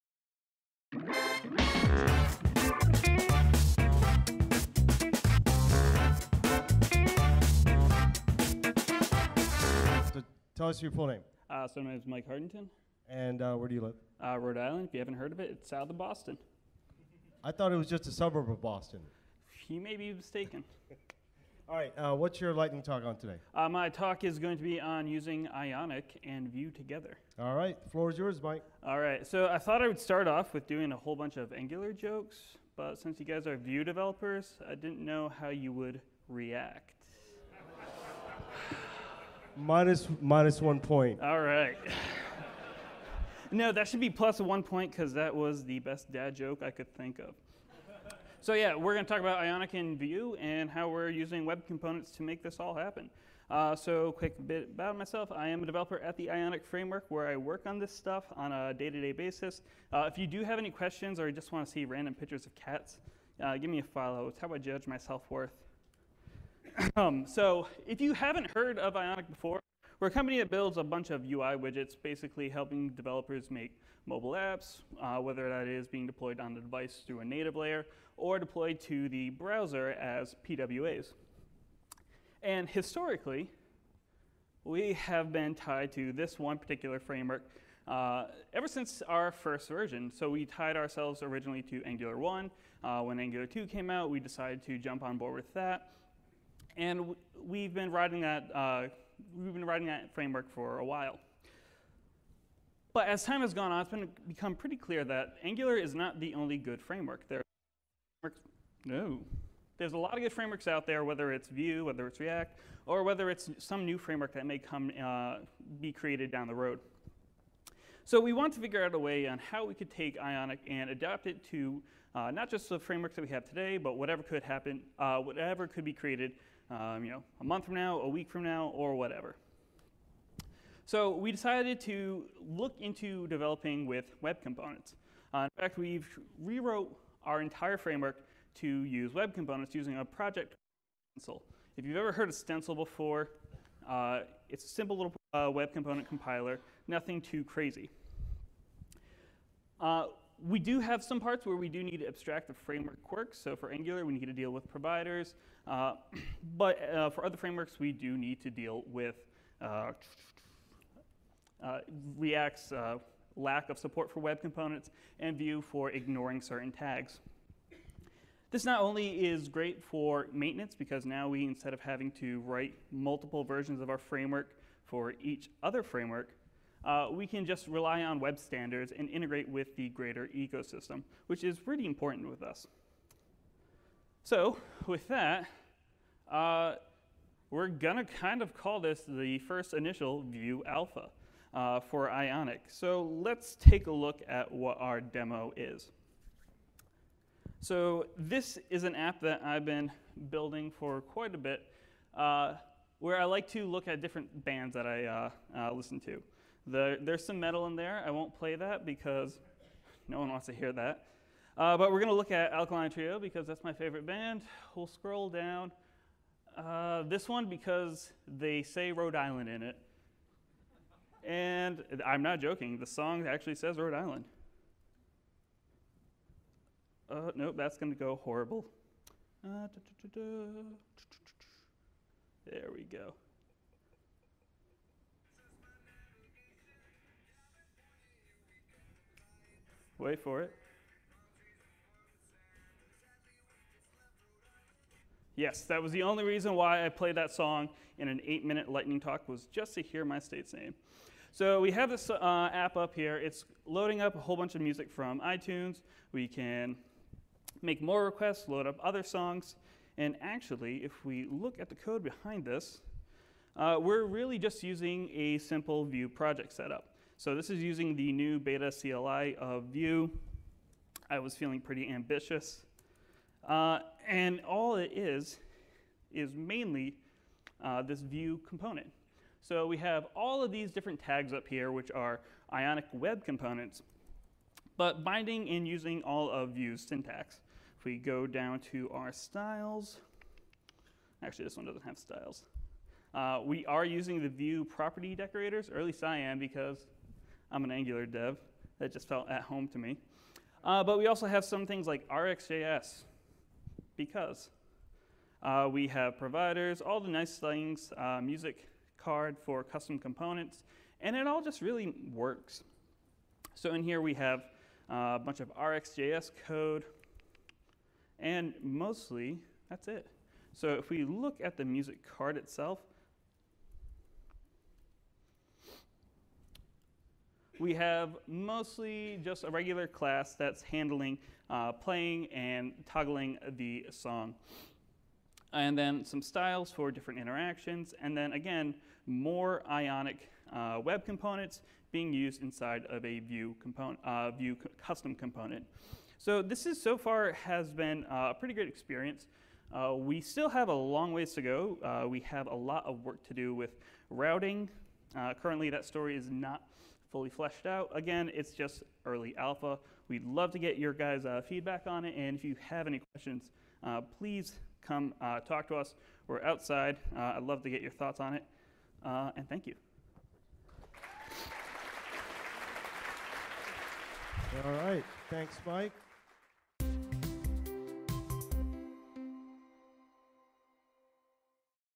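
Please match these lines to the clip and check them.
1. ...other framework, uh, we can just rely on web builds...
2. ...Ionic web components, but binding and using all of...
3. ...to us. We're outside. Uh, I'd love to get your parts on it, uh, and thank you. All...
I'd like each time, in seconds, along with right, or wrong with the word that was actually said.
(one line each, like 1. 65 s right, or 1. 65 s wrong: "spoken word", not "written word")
1. 175 s wrong: "standards", not "builds"
2. 282 s right
3. 365 s wrong: "thoughts", not "parts".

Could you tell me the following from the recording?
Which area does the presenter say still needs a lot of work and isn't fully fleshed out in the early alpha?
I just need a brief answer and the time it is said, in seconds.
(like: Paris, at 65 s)
Routing, at 354 s.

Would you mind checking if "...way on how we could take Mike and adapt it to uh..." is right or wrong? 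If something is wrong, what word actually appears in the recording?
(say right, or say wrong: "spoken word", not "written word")
wrong: "Ionic", not "Mike".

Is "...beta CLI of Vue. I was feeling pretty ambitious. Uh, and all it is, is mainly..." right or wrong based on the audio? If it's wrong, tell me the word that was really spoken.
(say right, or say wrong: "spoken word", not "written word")
right.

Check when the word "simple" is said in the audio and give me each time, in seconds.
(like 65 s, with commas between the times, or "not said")
144 s, 265 s.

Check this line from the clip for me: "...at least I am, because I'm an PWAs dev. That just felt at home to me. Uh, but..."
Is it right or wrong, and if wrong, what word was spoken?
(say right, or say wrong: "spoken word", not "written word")
wrong: "Angular", not "PWAs".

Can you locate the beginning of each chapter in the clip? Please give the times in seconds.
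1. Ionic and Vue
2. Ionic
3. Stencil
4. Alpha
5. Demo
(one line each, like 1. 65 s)
1. 29 s
2. 66 s
3. 129 s
4. 183 s
5. 194 s.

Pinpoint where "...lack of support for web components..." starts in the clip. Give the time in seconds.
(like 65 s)
163 s.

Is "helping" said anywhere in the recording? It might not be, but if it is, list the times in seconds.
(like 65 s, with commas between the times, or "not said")
72 s.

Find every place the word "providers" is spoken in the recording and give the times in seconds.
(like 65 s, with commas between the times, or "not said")
154 s, 306 s.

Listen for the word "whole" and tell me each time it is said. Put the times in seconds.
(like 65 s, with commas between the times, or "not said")
30 s, 254 s.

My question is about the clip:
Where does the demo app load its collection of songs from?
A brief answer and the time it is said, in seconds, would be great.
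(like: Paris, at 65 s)
iTunes, at 255 s.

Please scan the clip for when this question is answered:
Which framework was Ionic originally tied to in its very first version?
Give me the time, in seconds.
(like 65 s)
91 s.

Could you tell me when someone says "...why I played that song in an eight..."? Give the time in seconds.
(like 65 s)
246 s.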